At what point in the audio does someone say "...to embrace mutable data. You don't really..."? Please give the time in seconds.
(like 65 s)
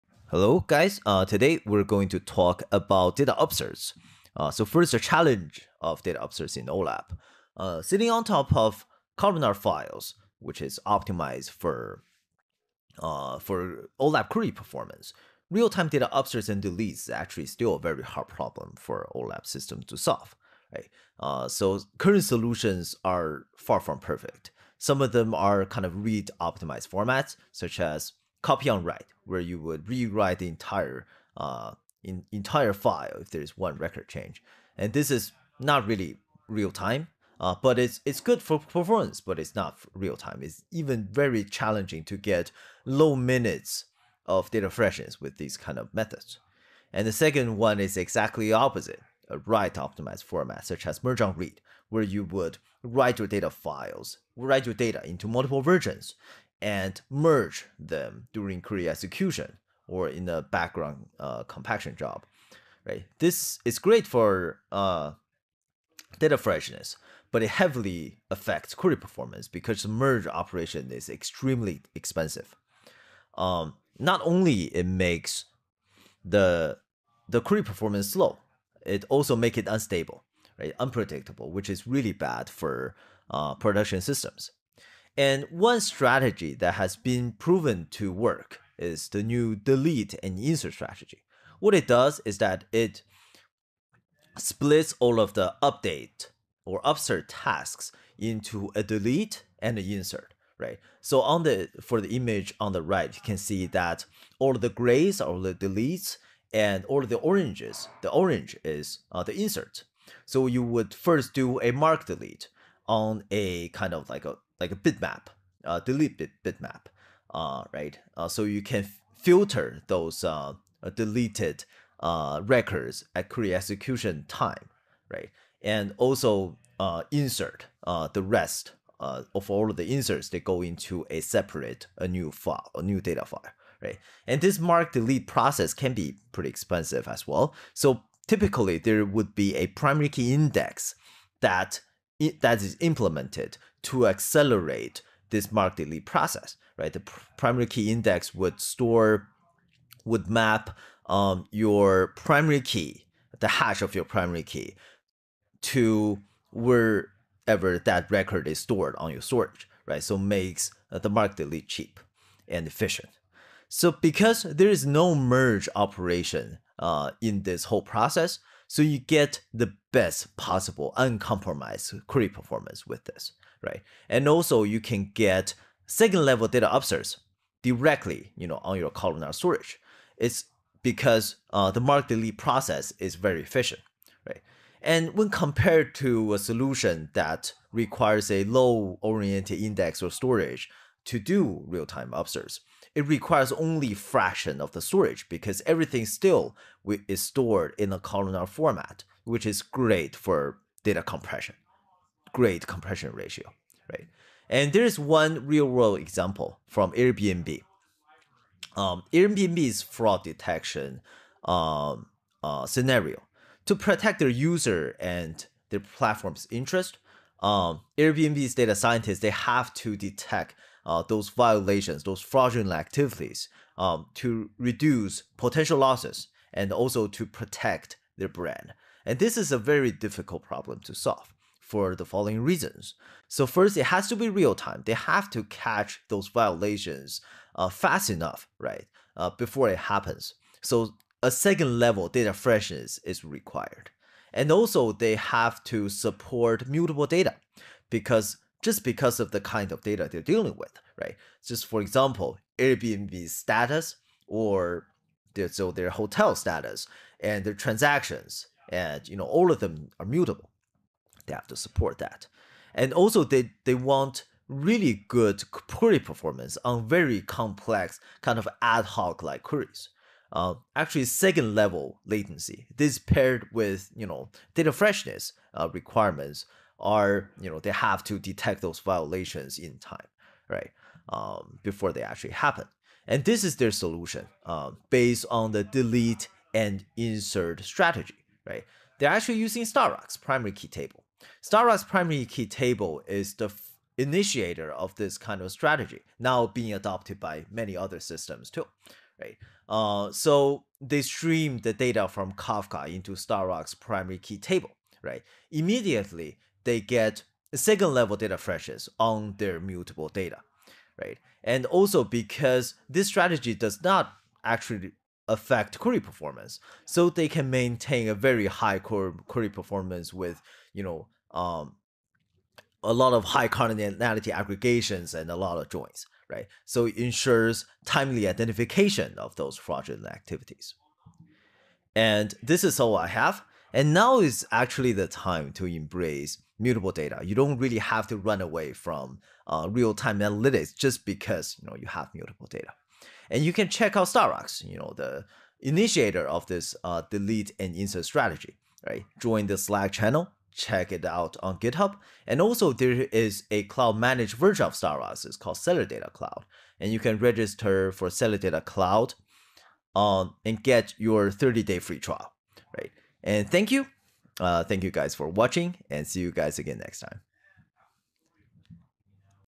335 s.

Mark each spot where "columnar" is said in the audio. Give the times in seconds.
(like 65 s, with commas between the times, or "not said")
9 s, 178 s, 197 s.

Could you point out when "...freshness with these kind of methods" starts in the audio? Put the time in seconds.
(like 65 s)
44 s.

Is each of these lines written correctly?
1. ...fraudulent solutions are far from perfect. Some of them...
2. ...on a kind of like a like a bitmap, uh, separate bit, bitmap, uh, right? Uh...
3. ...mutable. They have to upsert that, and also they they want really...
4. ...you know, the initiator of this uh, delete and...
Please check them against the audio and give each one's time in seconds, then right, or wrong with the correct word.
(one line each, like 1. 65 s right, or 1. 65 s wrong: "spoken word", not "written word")
1. 21 s wrong: "current", not "fraudulent"
2. 112 s wrong: "delete", not "separate"
3. 260 s wrong: "support", not "upsert"
4. 344 s right.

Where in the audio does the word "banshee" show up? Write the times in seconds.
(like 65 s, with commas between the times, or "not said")
not said.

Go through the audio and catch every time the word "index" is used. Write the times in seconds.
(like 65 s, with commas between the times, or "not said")
140 s, 147 s, 189 s.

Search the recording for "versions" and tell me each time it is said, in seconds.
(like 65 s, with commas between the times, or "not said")
55 s, 354 s.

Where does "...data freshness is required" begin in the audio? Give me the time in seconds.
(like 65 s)
242 s.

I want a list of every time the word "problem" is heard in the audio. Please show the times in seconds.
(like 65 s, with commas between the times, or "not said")
18 s, 230 s.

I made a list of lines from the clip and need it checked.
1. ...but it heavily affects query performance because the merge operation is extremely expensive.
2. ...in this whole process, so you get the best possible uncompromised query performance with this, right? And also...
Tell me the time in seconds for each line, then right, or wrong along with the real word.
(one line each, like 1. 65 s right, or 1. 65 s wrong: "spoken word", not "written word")
1. 67 s right
2. 167 s right.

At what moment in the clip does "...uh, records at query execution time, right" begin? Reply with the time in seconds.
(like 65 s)
121 s.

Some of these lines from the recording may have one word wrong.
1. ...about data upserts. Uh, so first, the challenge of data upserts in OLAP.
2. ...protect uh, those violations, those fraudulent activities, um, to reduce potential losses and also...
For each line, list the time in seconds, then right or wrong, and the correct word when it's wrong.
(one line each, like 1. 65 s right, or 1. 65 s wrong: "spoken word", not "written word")
1. 2 s right
2. 219 s wrong: "detect", not "protect".